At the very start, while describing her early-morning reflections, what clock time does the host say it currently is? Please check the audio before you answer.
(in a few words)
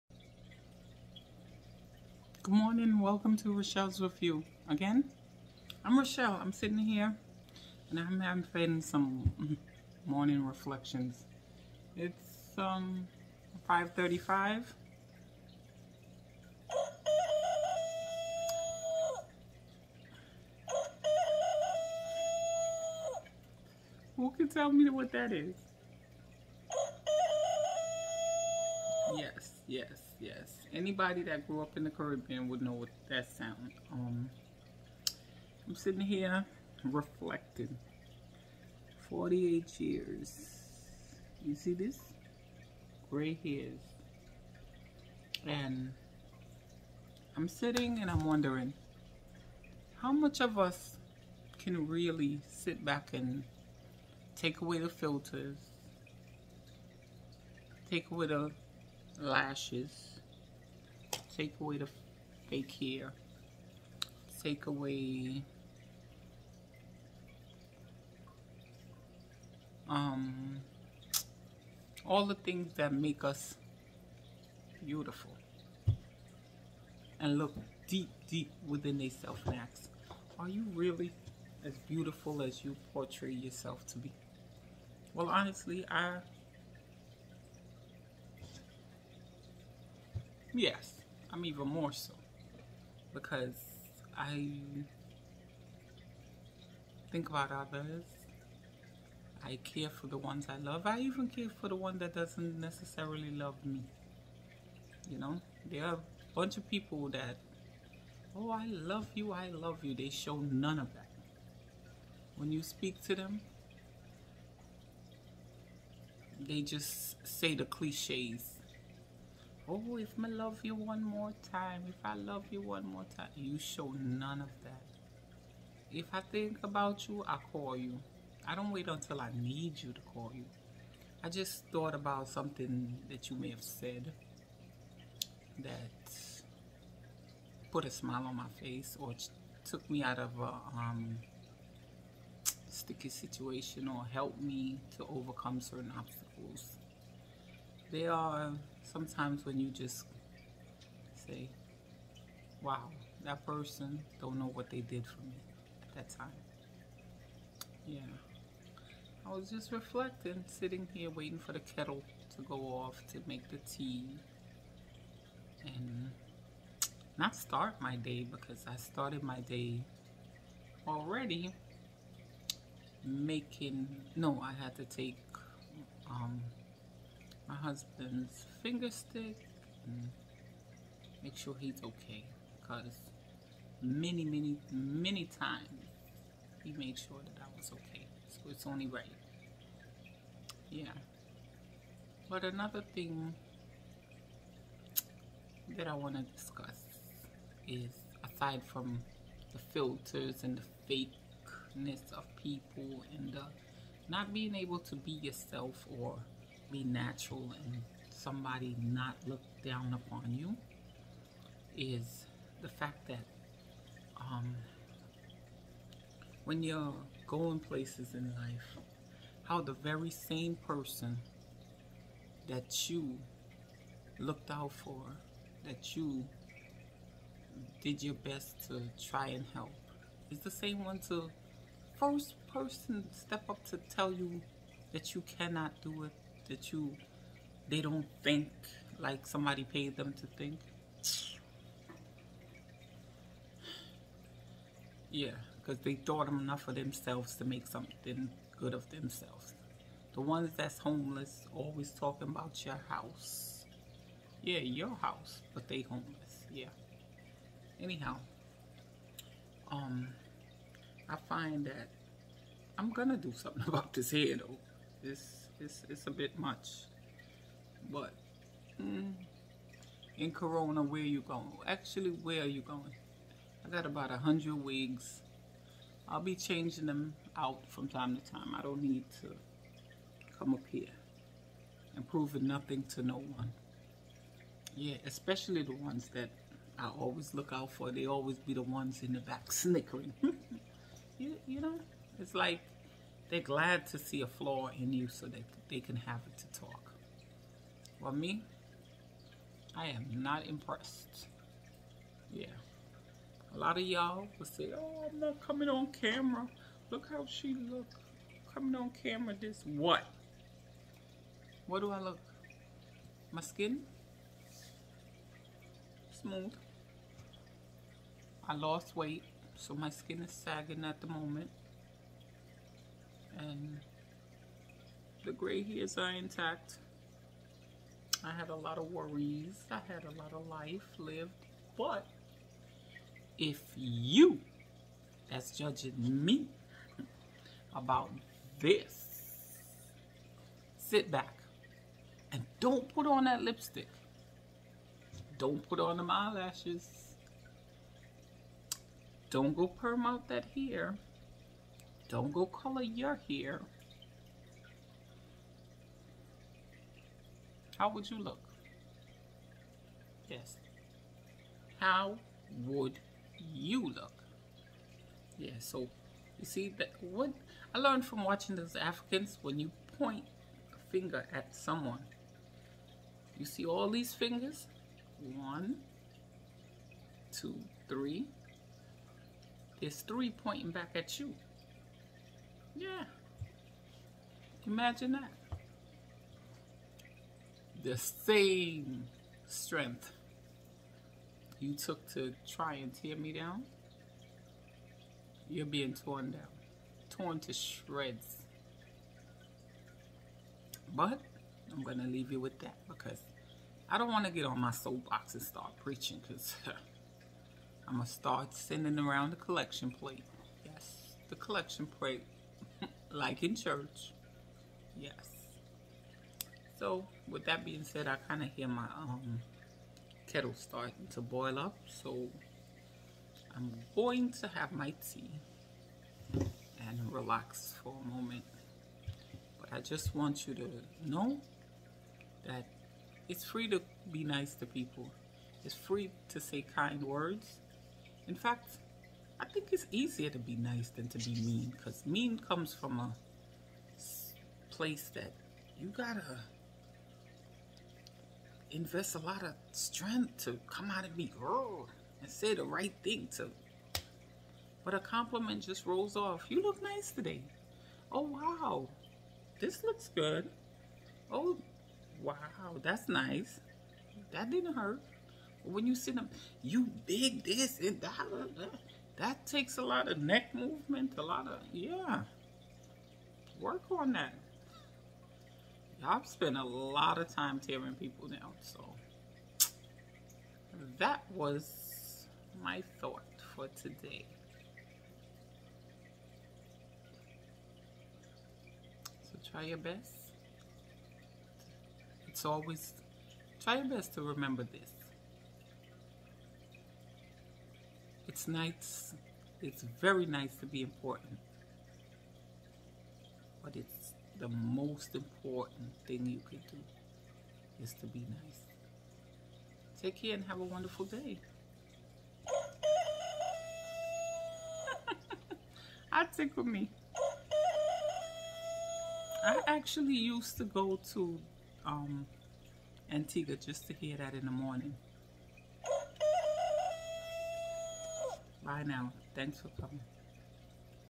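5:35.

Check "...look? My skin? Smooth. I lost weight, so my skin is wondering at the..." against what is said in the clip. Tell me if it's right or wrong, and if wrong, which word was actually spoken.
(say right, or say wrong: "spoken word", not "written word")
wrong: "sagging", not "wondering".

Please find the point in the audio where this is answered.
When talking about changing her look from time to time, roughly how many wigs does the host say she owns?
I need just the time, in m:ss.
4:34.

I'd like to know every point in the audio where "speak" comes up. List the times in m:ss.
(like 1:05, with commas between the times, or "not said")
1:52.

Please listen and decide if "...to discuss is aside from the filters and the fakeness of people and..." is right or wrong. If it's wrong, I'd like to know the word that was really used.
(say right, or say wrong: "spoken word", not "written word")
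right.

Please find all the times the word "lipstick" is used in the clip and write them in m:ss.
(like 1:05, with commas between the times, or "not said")
5:43.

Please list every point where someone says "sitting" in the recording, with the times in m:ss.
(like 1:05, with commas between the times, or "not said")
0:06, 0:35, 0:47, 2:40.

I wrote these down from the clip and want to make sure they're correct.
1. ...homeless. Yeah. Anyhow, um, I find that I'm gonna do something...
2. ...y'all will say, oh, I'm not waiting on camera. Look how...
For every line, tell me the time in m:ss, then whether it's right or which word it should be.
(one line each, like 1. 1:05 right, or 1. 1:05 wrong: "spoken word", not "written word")
1. 4:15 right
2. 5:03 wrong: "coming", not "waiting".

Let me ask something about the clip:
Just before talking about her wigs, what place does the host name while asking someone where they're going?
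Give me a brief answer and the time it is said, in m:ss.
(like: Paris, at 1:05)
Corona, at 4:30.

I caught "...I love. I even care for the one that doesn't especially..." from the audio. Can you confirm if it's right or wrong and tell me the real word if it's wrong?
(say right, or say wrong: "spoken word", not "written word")
wrong: "necessarily", not "especially".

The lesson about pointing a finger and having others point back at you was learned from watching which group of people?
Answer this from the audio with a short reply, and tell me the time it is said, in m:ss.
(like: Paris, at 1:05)
Africans, at 6:08.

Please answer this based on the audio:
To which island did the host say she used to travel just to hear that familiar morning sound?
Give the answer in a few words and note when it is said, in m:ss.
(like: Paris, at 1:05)
Antigua, at 8:43.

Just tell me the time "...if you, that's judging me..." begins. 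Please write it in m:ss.
5:33.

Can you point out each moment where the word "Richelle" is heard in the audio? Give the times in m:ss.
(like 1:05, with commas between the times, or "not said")
0:03.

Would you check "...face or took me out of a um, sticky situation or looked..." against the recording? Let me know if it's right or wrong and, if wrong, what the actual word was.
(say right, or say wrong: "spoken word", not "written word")
wrong: "helped", not "looked".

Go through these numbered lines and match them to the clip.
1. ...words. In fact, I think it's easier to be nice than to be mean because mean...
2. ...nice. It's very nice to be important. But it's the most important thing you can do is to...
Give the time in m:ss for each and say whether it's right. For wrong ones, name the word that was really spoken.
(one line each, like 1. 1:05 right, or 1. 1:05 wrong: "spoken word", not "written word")
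1. 7:17 right
2. 8:18 right.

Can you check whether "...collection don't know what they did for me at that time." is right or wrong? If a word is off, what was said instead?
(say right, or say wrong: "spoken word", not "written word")
wrong: "person", not "collection".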